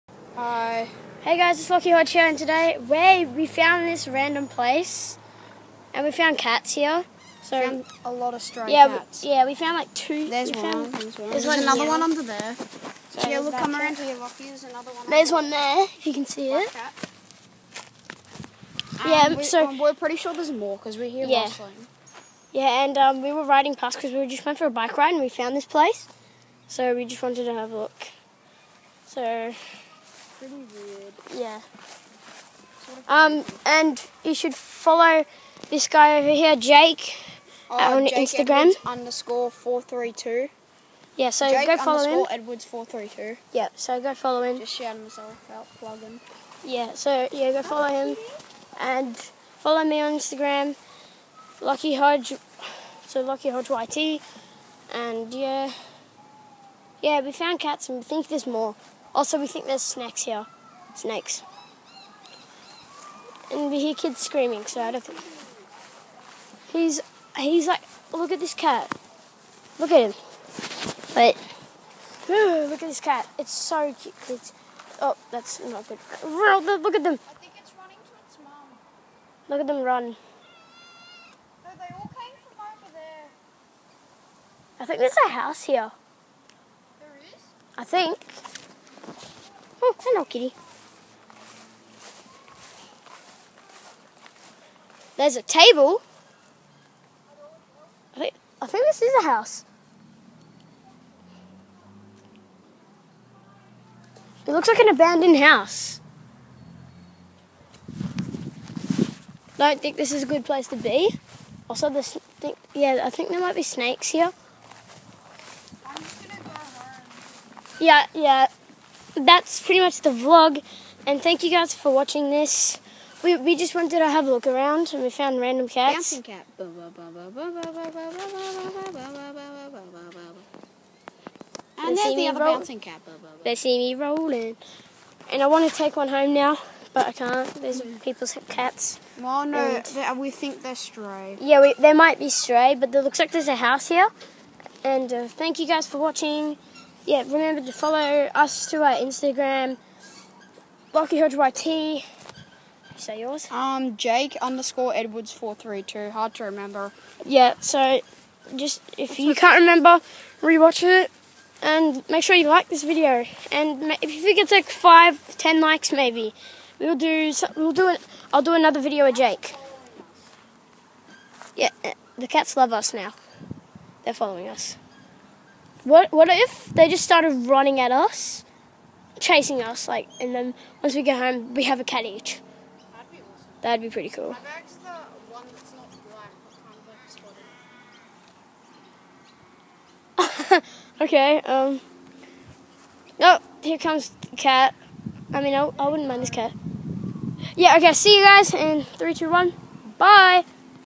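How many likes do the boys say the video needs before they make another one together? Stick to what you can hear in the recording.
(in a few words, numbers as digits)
5 to 10 likes.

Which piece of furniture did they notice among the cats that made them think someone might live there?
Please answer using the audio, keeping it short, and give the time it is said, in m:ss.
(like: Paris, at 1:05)
A table, at 1:35.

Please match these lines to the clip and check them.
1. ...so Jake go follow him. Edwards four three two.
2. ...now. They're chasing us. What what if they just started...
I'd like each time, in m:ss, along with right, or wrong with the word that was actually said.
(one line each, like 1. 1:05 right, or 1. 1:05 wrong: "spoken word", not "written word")
1. 0:41 right
2. 2:52 wrong: "following", not "chasing".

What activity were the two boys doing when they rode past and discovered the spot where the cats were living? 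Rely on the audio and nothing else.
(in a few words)
Bike ride.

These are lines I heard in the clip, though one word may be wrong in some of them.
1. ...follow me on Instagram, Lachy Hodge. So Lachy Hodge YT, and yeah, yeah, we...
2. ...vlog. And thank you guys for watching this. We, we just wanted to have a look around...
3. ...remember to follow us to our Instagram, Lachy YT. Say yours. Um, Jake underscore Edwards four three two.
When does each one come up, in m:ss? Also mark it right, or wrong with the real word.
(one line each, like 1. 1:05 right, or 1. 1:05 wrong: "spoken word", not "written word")
1. 0:49 right
2. 2:00 right
3. 2:27 right.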